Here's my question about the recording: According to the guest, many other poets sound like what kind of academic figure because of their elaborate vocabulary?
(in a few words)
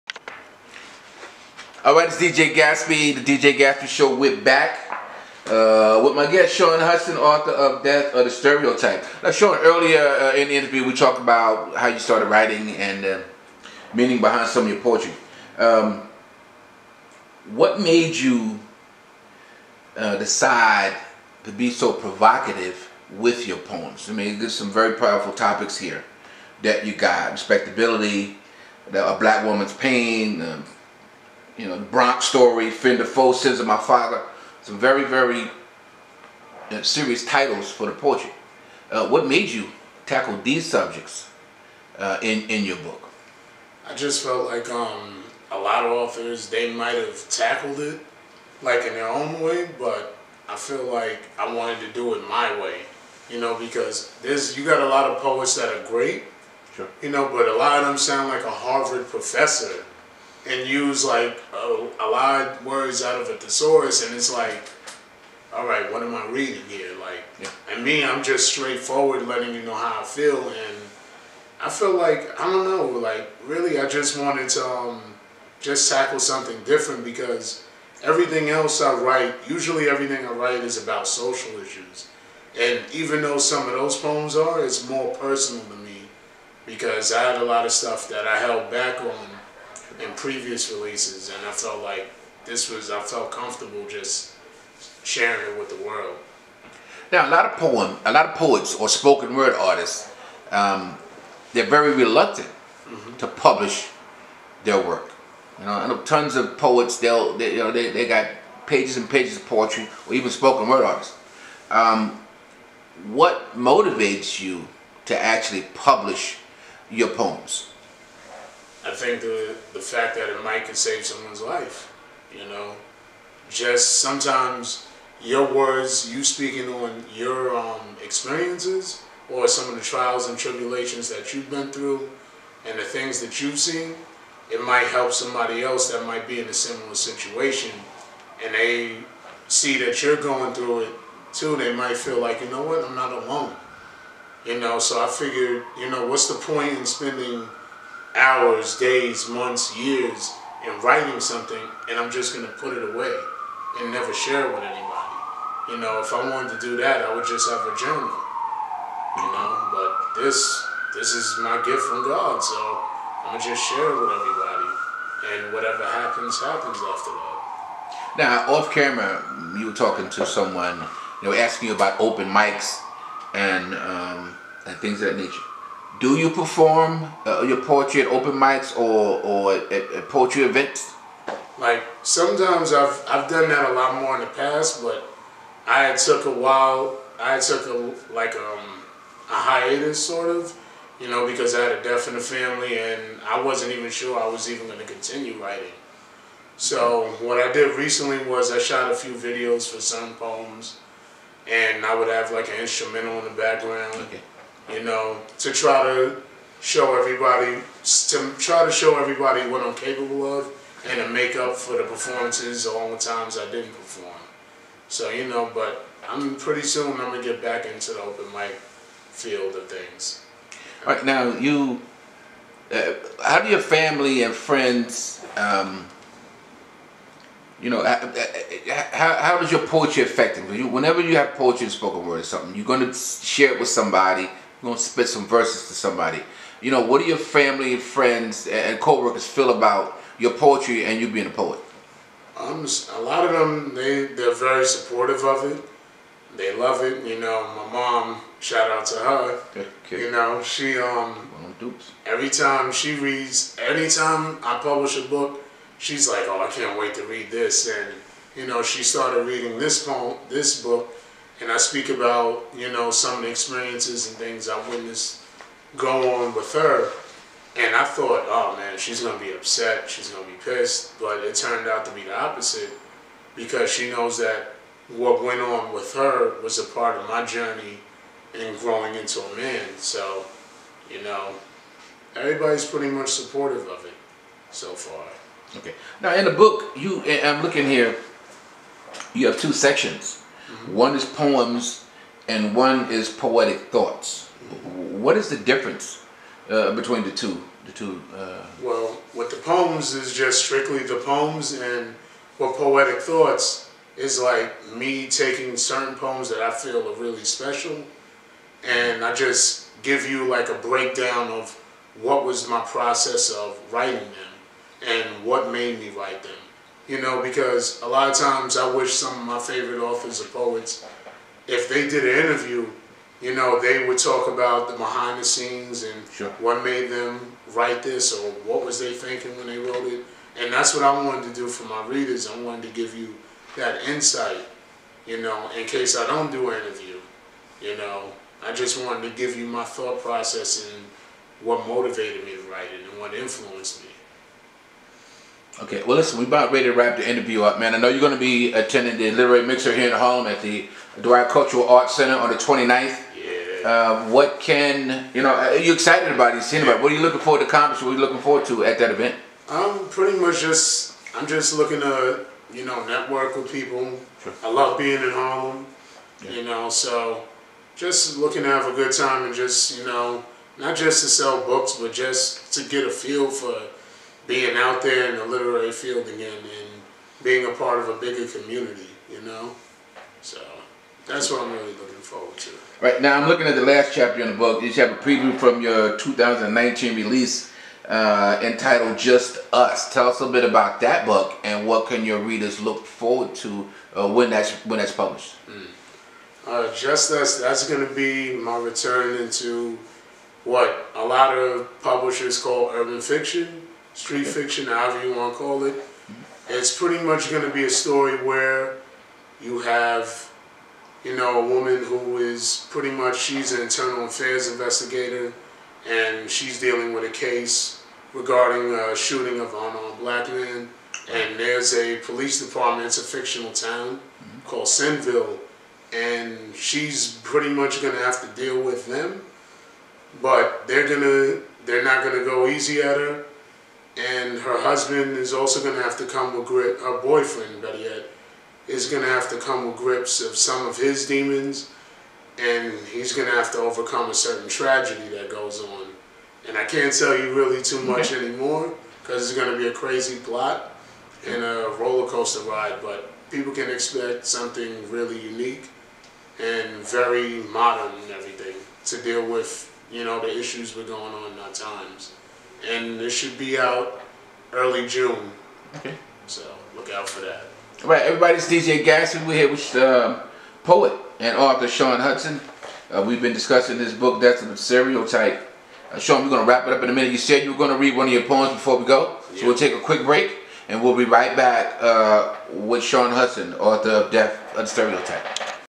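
Harvard professor.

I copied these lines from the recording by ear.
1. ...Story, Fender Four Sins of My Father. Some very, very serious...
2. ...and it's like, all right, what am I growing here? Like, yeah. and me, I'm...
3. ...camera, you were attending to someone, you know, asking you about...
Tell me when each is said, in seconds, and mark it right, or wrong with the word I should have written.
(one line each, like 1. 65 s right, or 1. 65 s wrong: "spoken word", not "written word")
1. 32 s right
2. 64 s wrong: "reading", not "growing"
3. 168 s wrong: "talking", not "attending".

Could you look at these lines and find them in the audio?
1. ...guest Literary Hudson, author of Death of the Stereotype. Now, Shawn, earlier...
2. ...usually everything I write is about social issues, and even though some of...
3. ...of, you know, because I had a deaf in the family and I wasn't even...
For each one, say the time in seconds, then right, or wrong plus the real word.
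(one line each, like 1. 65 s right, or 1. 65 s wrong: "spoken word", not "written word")
1. 6 s wrong: "Shawn", not "Literary"
2. 79 s right
3. 190 s right.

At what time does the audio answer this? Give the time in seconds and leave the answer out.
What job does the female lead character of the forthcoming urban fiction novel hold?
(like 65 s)
413 s.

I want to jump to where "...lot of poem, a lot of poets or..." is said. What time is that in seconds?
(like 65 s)
97 s.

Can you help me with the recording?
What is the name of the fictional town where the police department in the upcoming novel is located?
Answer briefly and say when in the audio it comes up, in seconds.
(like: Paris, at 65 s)
Sinville, at 424 s.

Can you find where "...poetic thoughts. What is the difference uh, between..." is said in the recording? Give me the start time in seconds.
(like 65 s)
293 s.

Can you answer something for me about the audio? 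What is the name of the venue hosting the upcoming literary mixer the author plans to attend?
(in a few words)
Dwight Cultural Arts Center.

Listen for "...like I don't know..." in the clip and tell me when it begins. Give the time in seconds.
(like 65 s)
71 s.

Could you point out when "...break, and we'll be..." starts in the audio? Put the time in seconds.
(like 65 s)
480 s.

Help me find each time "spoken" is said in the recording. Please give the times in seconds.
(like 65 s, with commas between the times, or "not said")
98 s, 110 s, 231 s.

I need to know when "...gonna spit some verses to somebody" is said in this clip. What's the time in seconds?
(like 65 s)
234 s.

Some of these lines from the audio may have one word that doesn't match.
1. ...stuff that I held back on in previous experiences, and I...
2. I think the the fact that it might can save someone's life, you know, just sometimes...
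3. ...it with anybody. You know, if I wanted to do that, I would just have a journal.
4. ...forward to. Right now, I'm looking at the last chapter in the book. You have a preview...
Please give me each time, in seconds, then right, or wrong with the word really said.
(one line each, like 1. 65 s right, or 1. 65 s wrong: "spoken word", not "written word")
1. 87 s wrong: "releases", not "experiences"
2. 118 s right
3. 154 s right
4. 381 s right.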